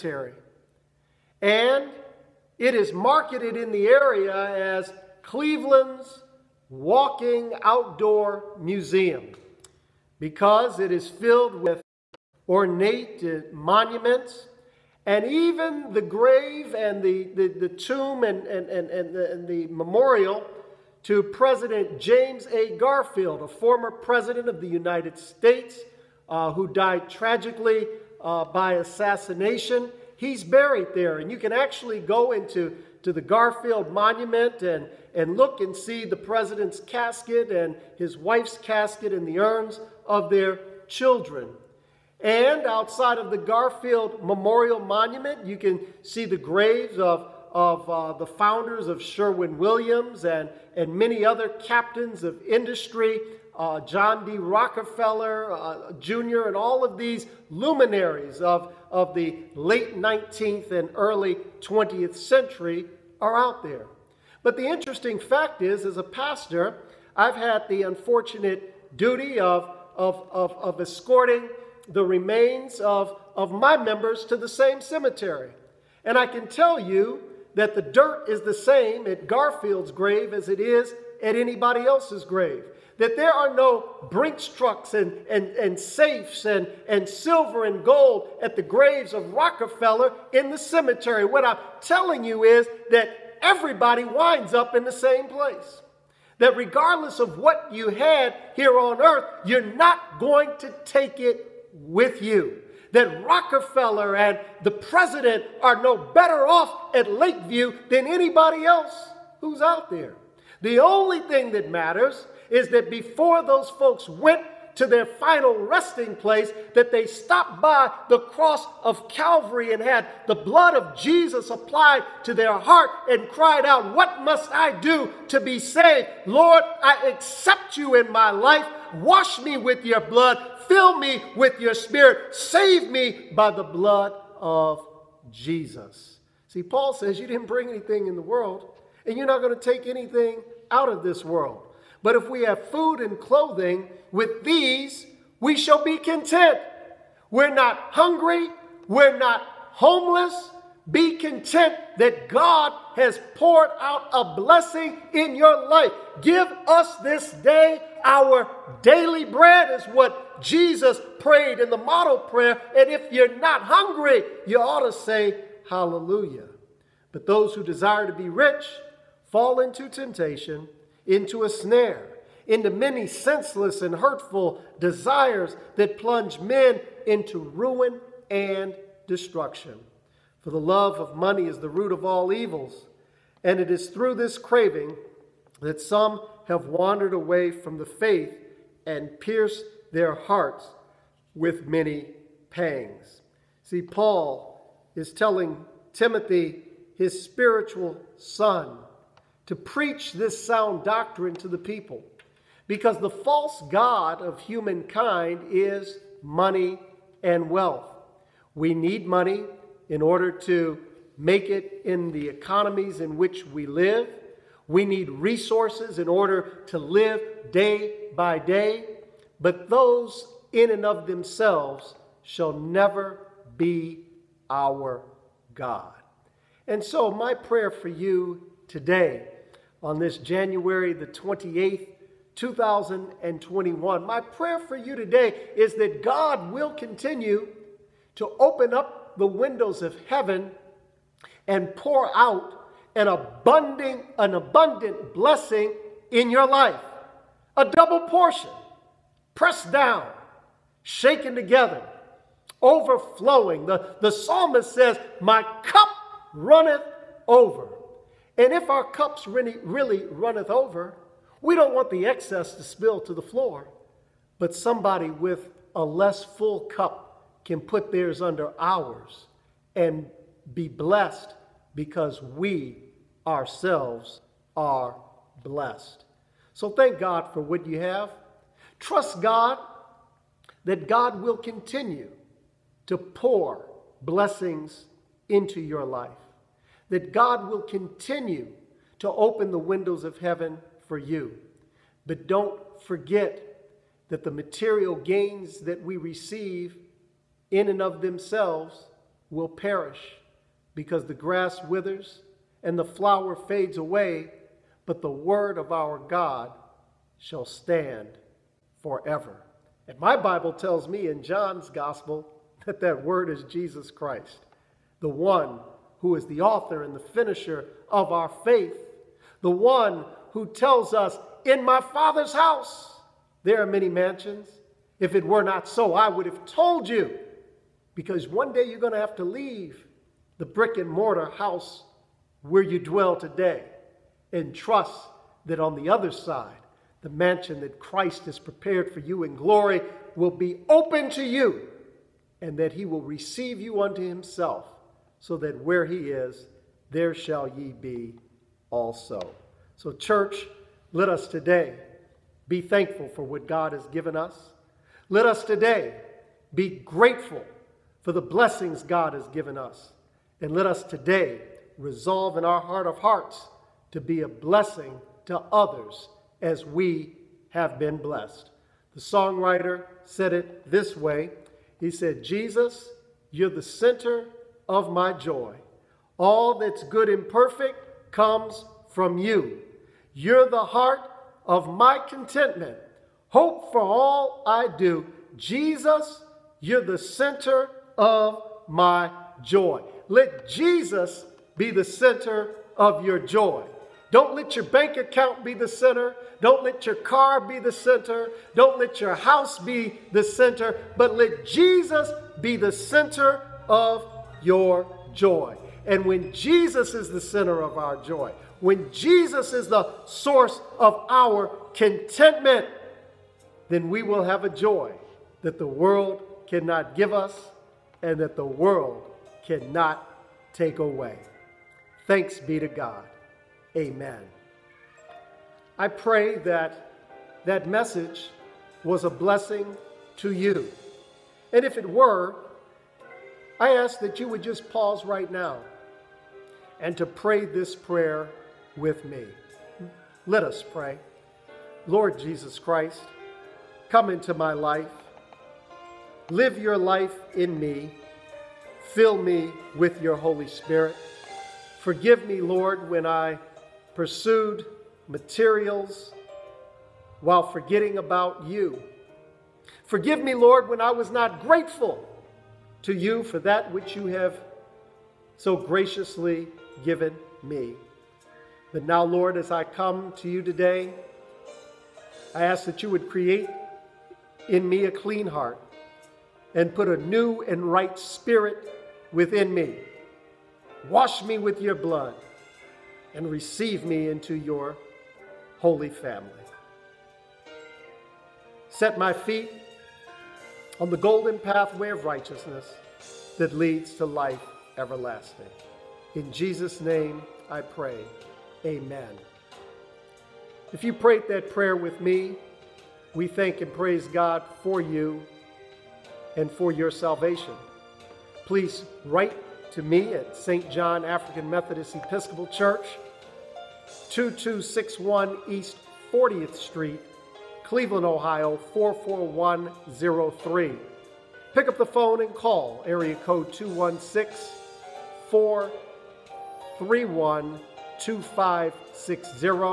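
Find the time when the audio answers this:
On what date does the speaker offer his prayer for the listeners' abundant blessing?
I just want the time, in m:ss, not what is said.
3:50.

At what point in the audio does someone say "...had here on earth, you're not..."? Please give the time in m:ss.
1:37.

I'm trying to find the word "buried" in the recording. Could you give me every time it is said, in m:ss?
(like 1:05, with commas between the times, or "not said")
0:30.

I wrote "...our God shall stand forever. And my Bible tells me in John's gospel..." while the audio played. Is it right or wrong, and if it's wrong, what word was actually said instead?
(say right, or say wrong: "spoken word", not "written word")
right.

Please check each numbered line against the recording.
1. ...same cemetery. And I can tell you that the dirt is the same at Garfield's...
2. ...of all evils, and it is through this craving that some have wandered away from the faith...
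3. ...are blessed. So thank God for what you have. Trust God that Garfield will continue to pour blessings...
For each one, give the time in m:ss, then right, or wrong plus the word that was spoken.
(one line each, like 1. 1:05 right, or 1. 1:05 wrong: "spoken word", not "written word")
1. 1:14 right
2. 3:01 right
3. 4:34 wrong: "God", not "Garfield".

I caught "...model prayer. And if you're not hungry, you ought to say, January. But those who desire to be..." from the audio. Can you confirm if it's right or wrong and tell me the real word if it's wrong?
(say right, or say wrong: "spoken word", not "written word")
wrong: "Hallelujah", not "January".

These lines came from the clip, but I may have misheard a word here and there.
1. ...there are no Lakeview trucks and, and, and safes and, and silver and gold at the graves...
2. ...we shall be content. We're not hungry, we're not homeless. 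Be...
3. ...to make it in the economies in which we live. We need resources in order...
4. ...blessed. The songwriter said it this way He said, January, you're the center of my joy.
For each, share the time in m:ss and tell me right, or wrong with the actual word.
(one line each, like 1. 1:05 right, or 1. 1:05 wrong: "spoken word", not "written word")
1. 1:23 wrong: "Brinks", not "Lakeview"
2. 2:25 right
3. 3:30 right
4. 6:07 wrong: "Jesus", not "January".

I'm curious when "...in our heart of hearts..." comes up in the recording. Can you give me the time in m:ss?
6:02.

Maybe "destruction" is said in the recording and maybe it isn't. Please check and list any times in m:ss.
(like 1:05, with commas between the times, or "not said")
2:59.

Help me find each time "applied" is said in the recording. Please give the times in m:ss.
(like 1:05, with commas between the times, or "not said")
2:01.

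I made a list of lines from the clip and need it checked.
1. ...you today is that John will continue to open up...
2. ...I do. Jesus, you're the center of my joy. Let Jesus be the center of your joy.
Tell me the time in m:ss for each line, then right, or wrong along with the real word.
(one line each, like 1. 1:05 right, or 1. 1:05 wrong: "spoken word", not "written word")
1. 3:54 wrong: "God", not "John"
2. 6:24 right.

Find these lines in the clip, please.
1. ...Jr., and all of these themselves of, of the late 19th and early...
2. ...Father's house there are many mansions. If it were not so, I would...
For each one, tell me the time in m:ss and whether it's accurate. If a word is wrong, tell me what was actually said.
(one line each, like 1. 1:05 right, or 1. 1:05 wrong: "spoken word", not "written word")
1. 0:55 wrong: "luminaries", not "themselves"
2. 5:21 right.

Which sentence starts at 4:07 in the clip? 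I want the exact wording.
A double portion, pressed down, shaken together, overflowing.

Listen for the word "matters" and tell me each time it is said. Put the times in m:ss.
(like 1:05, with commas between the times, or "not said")
1:51.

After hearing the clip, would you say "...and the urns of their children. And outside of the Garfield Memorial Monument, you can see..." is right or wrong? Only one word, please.
right.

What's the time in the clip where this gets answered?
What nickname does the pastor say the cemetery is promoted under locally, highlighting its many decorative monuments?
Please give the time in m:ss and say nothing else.
0:05.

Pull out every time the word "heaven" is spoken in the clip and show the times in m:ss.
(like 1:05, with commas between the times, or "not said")
4:00, 4:50.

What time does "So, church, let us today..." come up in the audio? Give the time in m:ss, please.
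5:49.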